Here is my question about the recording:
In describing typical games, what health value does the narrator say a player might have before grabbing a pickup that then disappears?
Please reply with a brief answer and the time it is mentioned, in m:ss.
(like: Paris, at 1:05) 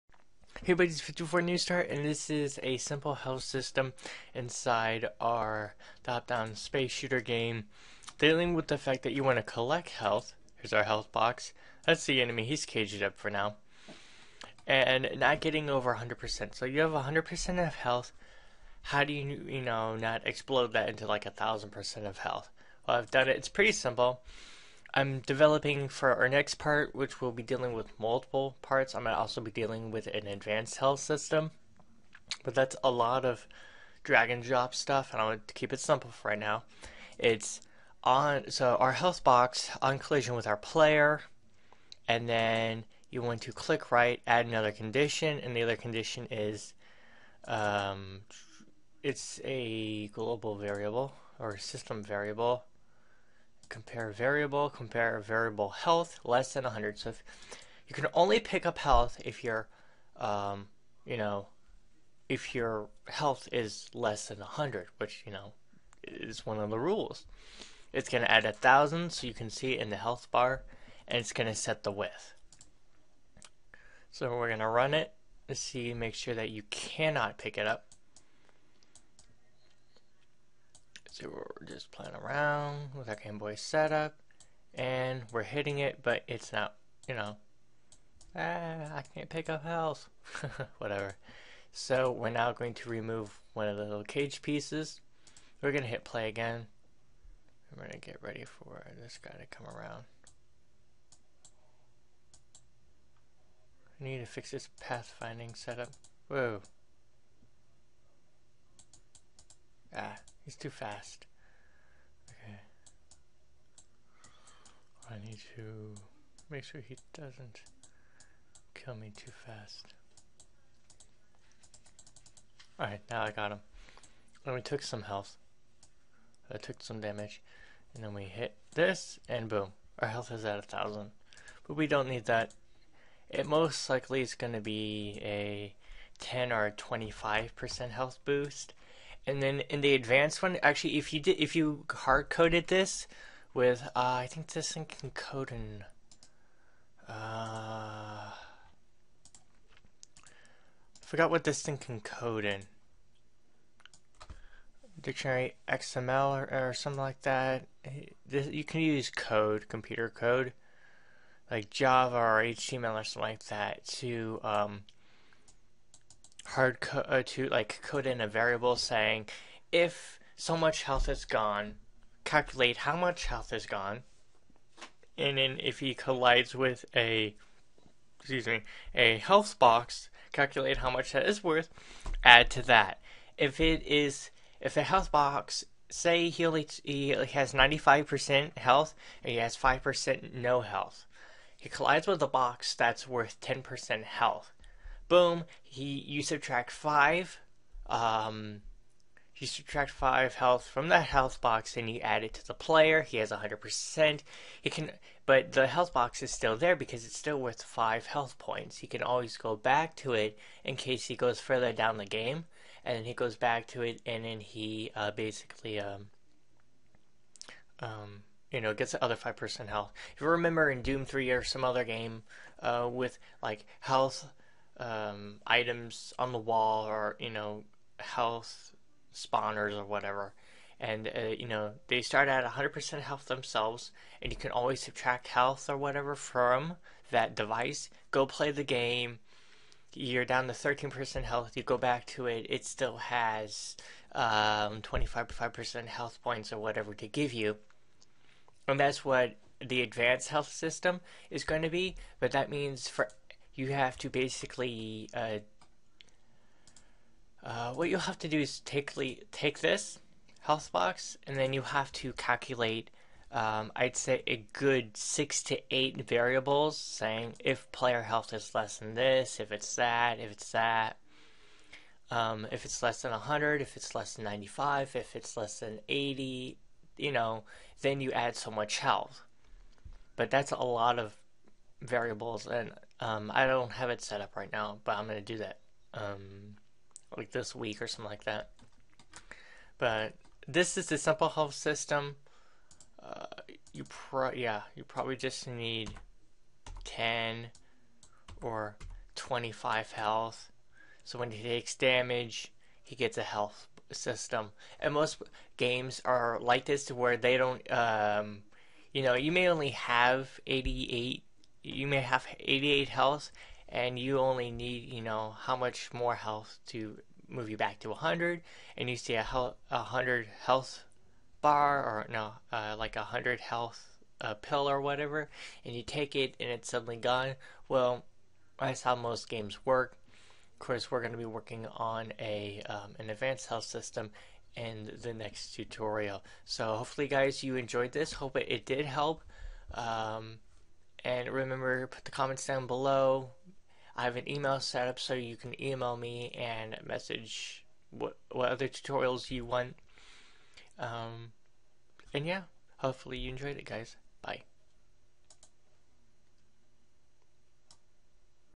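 88, at 5:12.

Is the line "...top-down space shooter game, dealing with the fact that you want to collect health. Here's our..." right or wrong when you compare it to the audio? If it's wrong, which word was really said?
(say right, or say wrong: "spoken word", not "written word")
right.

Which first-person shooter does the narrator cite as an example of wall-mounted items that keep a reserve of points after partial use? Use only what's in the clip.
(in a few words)
Doom 3.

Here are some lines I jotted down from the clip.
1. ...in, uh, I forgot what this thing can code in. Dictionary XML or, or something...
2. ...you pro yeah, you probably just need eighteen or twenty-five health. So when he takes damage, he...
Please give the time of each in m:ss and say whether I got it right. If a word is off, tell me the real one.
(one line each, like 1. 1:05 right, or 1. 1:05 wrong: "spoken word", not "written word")
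1. 2:25 right
2. 4:53 wrong: "ten", not "eighteen".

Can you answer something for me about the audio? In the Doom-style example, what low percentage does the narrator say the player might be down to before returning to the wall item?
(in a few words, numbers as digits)
13%.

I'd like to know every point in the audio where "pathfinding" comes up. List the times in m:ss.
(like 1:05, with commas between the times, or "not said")
1:44.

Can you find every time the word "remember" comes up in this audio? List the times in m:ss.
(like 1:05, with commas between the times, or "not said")
3:40, 5:41.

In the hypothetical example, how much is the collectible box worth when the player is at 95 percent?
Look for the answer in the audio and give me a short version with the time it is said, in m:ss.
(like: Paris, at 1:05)
10%, at 3:13.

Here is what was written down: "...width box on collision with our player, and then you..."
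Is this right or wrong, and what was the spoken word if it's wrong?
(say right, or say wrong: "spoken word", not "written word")
wrong: "health", not "width".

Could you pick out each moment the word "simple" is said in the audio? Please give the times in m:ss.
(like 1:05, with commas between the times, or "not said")
0:02, 0:23, 0:35, 4:50.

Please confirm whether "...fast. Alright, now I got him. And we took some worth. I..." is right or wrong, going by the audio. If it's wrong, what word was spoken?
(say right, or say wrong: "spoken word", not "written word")
wrong: "health", not "worth".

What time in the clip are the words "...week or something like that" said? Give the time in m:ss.
4:47.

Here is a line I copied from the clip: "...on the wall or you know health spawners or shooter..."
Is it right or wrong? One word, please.
wrong.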